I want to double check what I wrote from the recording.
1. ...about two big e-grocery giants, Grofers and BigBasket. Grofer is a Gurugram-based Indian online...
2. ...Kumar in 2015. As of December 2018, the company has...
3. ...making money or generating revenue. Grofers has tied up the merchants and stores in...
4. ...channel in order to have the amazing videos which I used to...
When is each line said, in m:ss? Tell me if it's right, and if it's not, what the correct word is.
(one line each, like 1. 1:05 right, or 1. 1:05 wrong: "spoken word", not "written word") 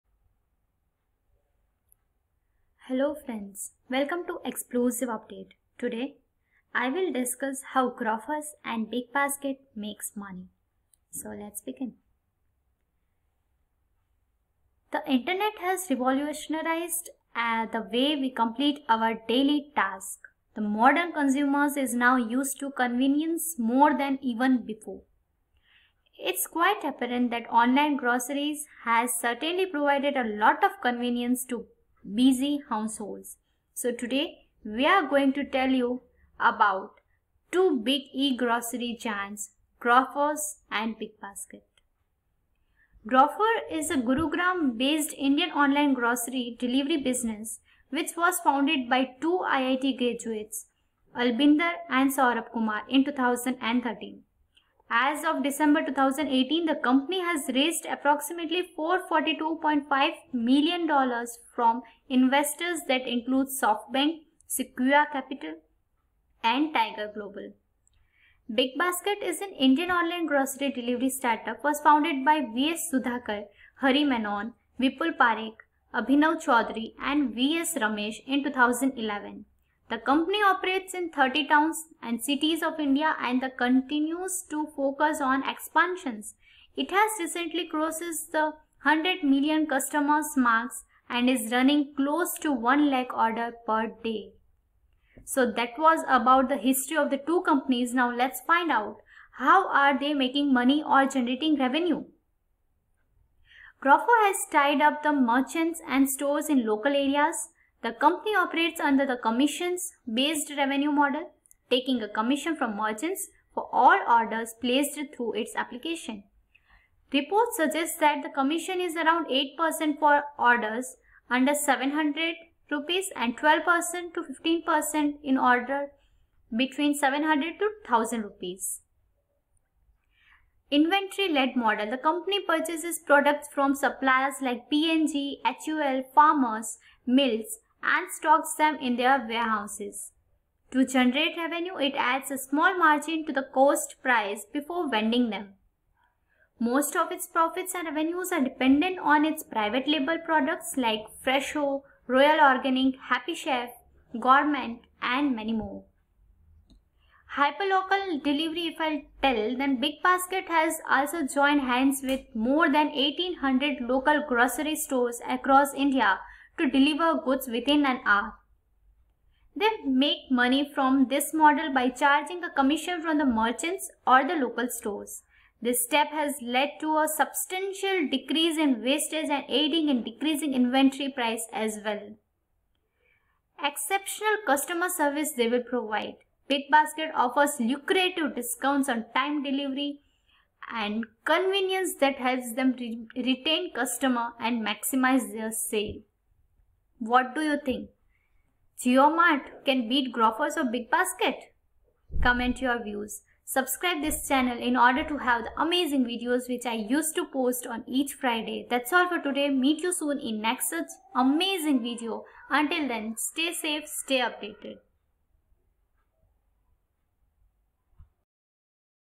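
1. 0:36 right
2. 0:52 wrong: "2013", not "2015"
3. 1:40 right
4. 3:24 right.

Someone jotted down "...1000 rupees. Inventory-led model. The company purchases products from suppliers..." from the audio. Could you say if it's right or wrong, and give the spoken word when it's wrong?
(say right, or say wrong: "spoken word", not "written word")
right.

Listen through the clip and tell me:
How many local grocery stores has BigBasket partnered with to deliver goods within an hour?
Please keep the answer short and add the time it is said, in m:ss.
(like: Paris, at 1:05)
1800, at 2:42.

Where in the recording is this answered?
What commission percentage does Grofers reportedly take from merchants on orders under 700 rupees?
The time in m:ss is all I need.
1:59.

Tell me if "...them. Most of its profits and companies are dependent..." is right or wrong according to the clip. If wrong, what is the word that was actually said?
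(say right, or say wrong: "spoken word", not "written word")
wrong: "revenues", not "companies".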